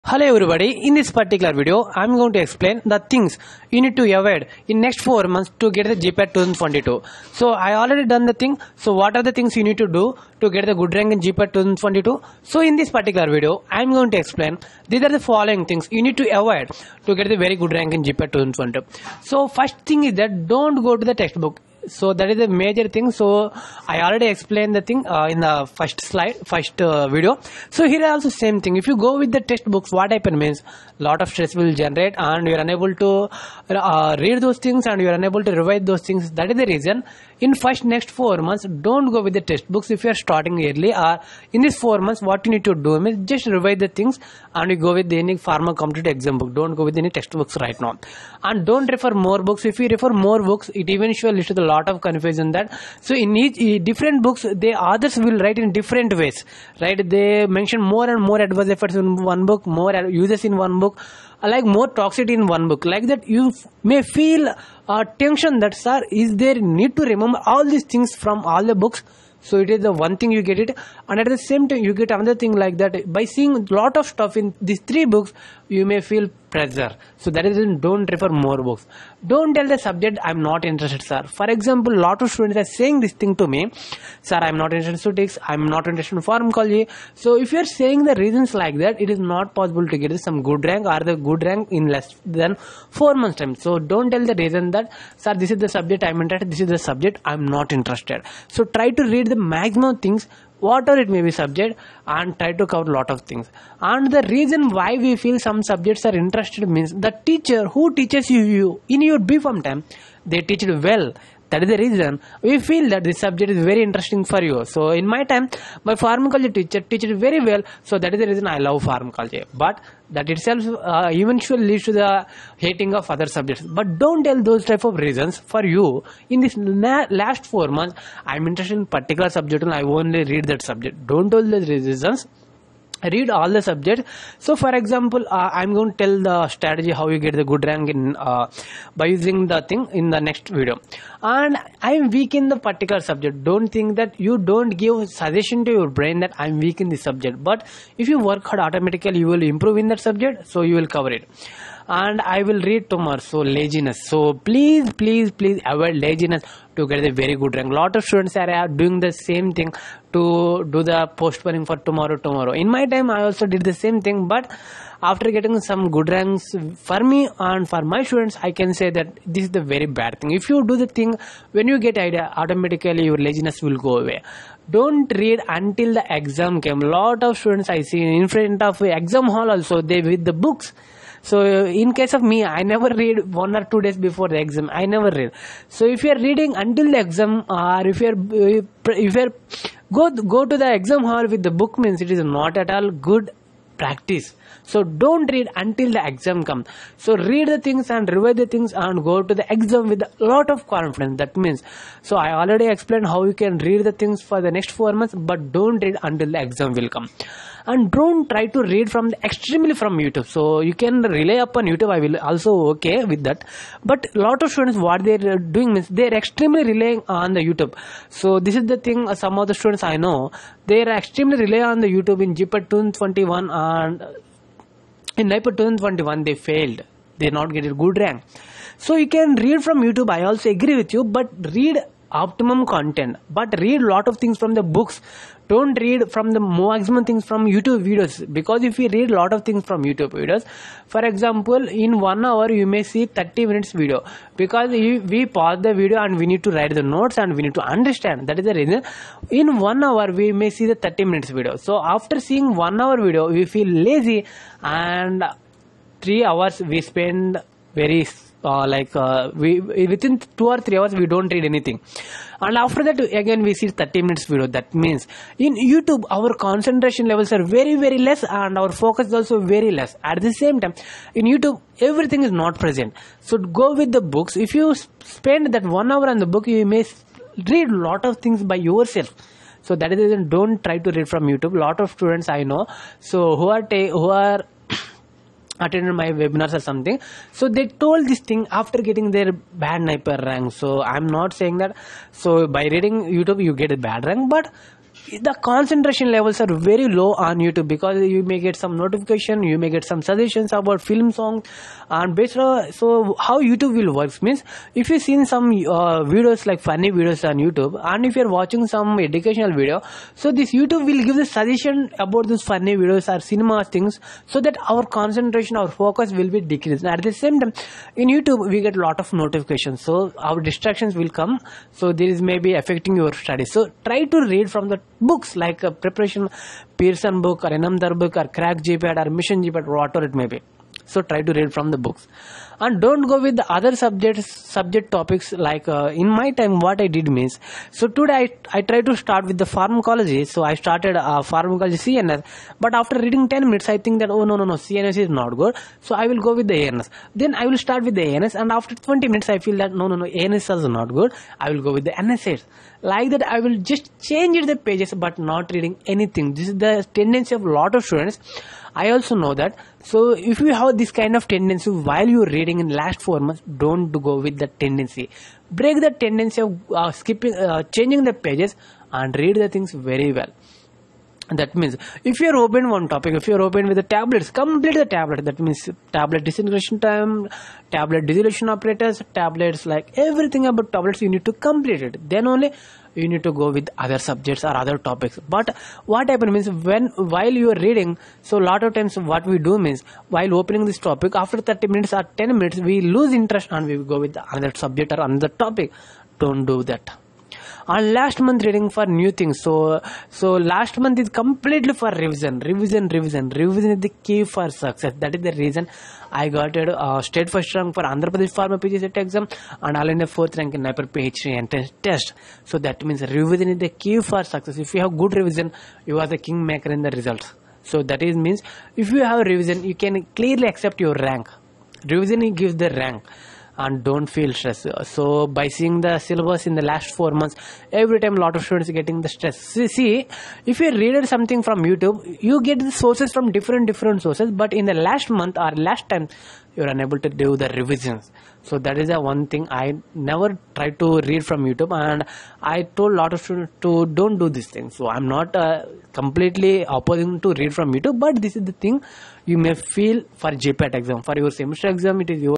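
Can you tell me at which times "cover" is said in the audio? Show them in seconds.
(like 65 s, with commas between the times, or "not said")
102 s, 150 s.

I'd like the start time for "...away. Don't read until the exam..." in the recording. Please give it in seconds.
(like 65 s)
173 s.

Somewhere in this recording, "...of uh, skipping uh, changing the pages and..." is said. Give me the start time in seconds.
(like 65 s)
366 s.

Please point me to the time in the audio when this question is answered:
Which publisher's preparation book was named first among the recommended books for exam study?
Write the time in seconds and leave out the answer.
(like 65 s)
325 s.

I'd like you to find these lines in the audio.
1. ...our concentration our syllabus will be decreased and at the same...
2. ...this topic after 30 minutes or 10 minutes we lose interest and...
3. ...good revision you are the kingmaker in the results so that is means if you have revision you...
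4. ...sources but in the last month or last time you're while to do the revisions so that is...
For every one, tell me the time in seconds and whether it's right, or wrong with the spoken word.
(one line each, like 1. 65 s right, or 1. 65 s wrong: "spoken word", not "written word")
1. 314 s wrong: "focus", not "syllabus"
2. 390 s right
3. 415 s right
4. 434 s wrong: "unable", not "while".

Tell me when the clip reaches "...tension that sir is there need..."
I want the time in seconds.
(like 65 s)
65 s.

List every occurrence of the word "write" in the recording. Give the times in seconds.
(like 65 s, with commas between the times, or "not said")
55 s, 246 s.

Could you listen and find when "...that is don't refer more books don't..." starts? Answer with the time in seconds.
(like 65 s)
77 s.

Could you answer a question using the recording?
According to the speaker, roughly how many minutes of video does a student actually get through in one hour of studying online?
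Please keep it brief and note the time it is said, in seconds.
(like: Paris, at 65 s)
30 minutes, at 249 s.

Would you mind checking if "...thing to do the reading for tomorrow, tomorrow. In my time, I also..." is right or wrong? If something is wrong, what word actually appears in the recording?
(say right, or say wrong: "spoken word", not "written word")
wrong: "postponing", not "reading".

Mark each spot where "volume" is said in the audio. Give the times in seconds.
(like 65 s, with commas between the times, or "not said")
not said.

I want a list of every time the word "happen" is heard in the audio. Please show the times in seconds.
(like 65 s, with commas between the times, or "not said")
30 s, 386 s.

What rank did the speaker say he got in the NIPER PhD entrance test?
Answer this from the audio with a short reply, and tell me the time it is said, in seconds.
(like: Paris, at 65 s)
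fourth rank, at 410 s.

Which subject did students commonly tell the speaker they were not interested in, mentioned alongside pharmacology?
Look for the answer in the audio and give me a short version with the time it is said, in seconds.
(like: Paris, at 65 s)
statistics, at 85 s.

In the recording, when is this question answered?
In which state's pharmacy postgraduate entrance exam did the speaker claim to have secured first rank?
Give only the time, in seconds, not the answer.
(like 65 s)
407 s.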